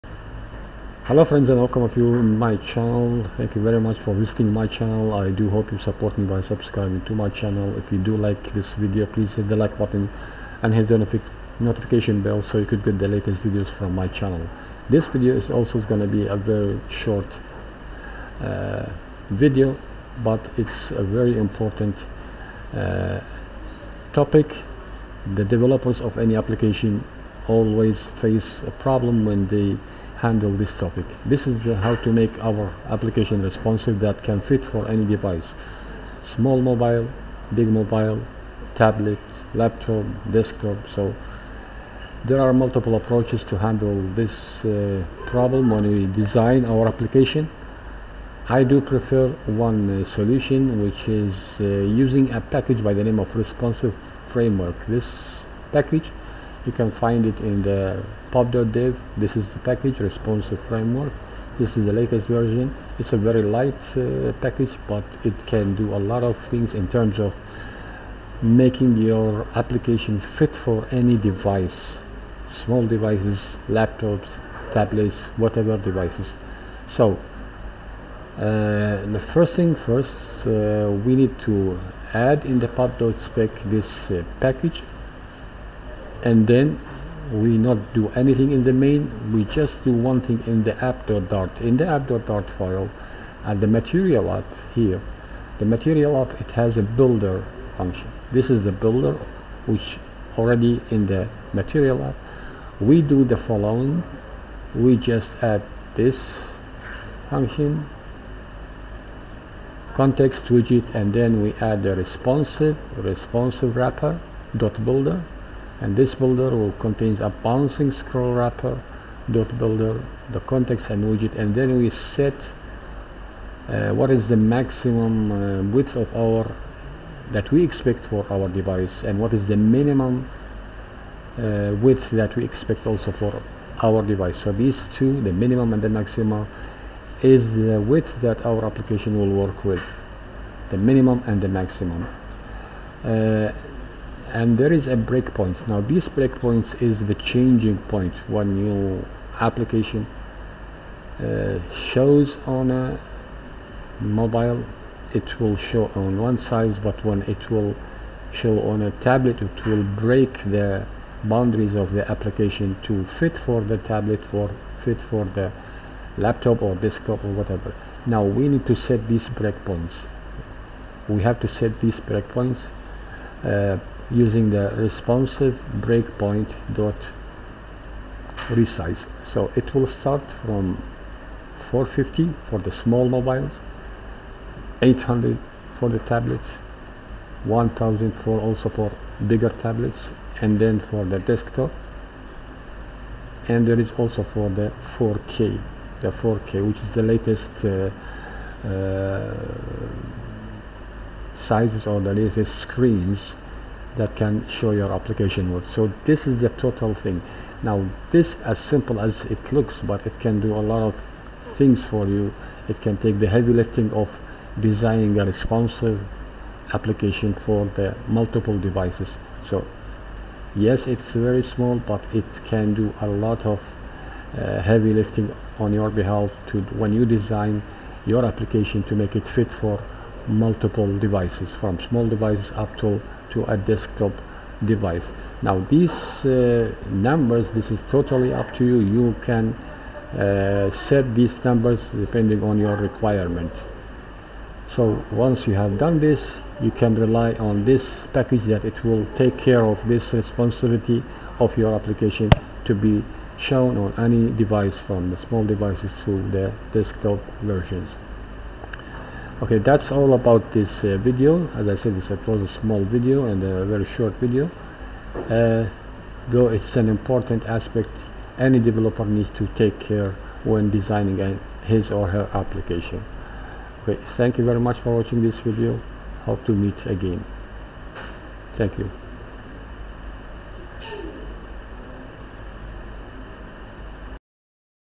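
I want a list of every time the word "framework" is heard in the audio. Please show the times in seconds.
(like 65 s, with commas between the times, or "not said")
53 s, 60 s.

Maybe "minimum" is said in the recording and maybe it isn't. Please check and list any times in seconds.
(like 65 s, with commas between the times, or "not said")
129 s, 135 s, 140 s.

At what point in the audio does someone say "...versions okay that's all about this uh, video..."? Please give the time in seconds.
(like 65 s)
257 s.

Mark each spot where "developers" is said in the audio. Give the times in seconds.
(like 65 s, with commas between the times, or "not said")
25 s, 268 s.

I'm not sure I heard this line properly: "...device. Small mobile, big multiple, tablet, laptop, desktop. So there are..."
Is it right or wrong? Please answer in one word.
wrong.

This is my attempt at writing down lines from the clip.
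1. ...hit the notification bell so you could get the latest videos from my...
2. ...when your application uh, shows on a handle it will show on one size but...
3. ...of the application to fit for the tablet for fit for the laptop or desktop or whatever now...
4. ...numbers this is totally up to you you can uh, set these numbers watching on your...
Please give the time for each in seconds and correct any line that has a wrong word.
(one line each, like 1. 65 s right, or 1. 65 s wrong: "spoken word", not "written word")
1. 10 s right
2. 148 s wrong: "mobile", not "handle"
3. 161 s right
4. 236 s wrong: "depending", not "watching".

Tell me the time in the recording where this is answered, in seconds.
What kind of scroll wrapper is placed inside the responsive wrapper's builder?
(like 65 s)
117 s.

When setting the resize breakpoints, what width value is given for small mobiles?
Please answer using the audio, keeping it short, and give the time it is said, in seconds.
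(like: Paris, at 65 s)
450, at 181 s.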